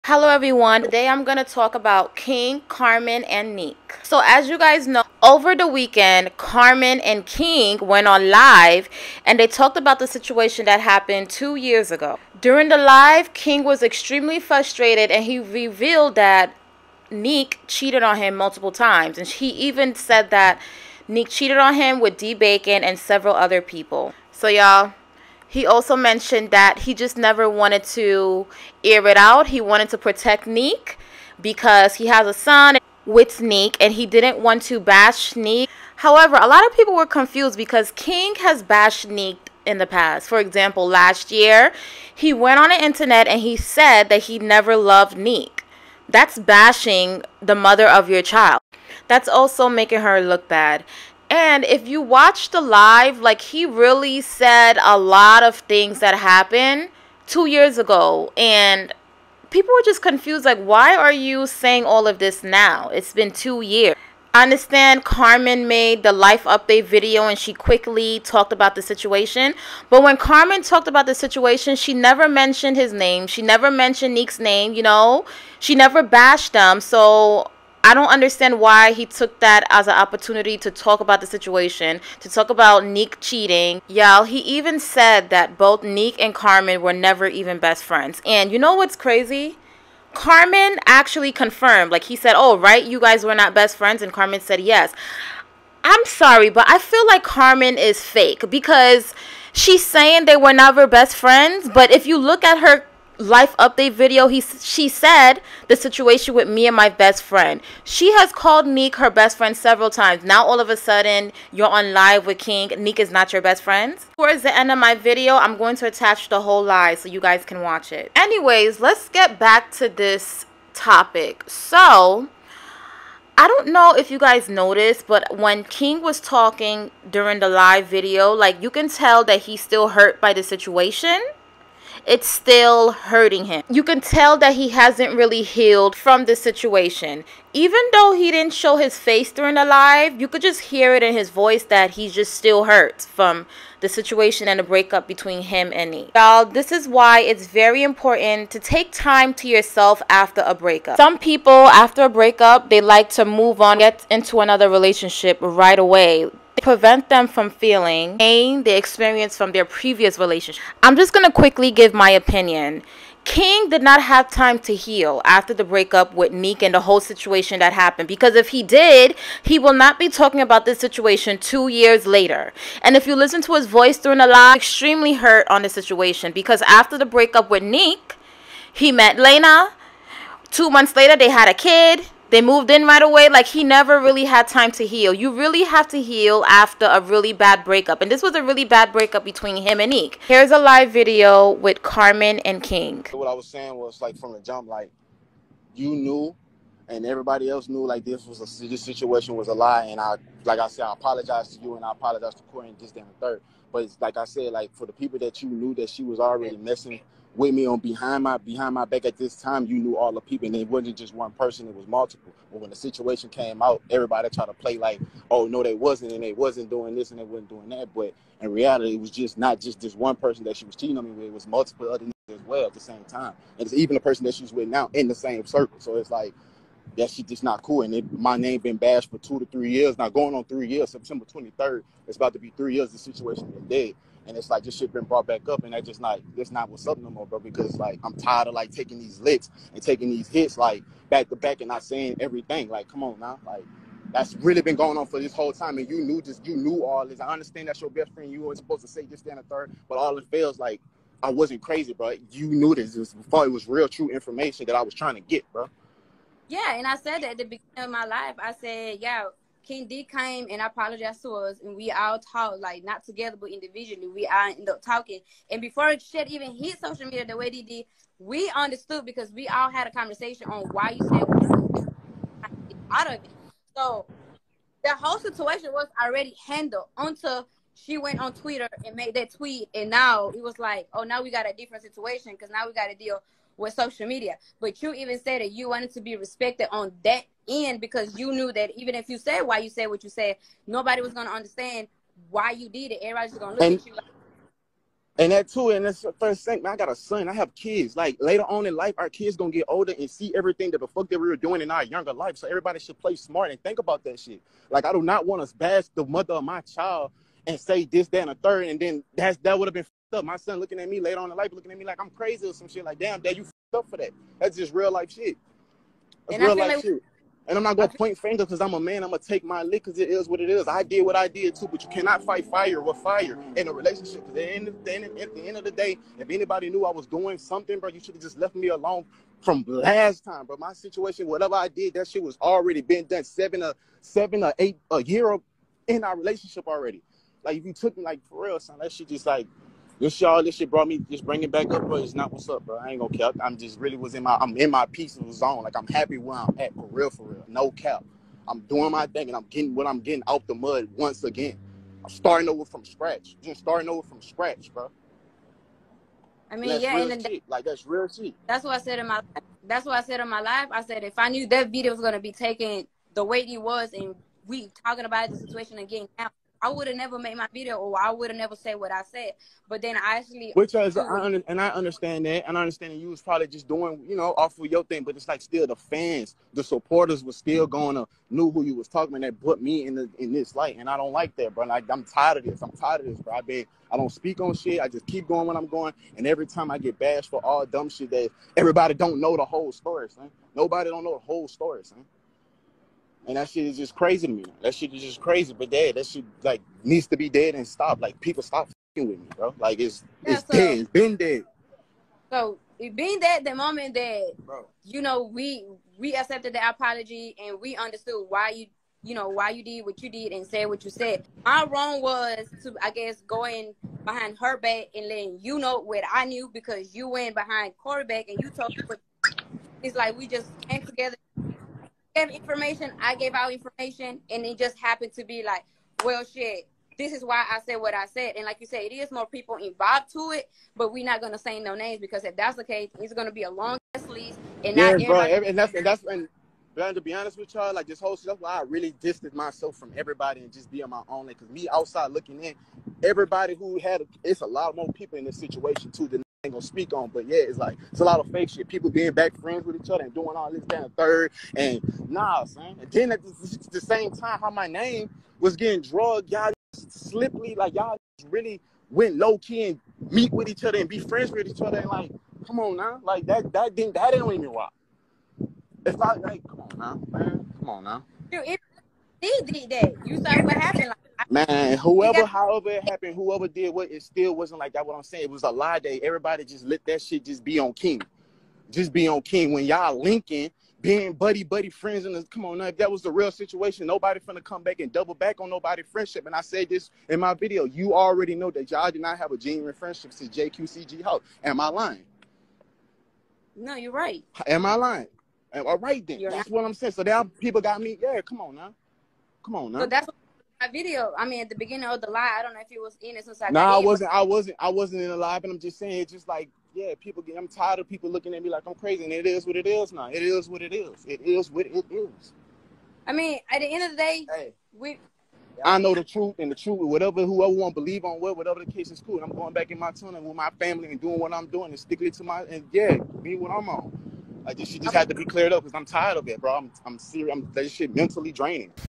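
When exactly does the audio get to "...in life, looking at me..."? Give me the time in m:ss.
5:11.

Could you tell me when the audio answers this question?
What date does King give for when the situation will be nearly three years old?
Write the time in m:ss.
3:50.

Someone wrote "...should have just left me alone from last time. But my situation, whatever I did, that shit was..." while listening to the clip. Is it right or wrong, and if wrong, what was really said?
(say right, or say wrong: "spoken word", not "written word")
right.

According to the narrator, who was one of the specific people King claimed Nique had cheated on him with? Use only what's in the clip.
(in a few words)
D Bacon.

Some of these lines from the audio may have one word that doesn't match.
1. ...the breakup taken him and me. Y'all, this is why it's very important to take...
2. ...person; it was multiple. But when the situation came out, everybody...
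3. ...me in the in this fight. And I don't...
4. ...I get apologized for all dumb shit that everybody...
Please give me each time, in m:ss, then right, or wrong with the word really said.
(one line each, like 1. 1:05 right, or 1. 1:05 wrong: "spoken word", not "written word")
1. 2:24 wrong: "between", not "taken"
2. 3:31 right
3. 6:19 wrong: "light", not "fight"
4. 6:26 wrong: "bashed", not "apologized".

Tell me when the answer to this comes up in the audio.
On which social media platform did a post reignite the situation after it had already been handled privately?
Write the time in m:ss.
4:38.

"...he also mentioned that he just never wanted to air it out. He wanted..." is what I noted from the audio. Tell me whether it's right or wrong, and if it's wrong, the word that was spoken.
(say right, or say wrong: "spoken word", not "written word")
right.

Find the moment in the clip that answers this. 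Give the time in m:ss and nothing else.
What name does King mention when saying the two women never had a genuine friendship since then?
8:10.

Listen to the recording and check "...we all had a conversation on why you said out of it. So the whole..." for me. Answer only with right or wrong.
right.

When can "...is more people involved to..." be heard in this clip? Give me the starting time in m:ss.
7:08.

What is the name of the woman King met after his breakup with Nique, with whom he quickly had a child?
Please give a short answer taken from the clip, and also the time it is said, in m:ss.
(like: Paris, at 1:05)
Lena, at 2:59.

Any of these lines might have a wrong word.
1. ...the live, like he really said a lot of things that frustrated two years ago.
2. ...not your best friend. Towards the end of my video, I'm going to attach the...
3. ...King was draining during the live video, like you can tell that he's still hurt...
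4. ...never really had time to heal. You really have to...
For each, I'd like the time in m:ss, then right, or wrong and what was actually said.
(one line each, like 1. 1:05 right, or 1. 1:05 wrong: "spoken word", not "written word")
1. 0:52 wrong: "happened", not "frustrated"
2. 1:53 right
3. 2:05 wrong: "talking", not "draining"
4. 3:03 right.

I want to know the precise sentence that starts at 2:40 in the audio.
I'm just going to quickly give my opinion.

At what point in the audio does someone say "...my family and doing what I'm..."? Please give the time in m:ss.
8:40.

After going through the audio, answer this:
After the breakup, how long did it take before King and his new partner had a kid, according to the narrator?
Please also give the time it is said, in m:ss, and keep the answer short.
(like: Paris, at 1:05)
Two months, at 3:00.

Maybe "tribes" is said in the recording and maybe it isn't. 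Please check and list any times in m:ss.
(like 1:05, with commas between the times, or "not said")
not said.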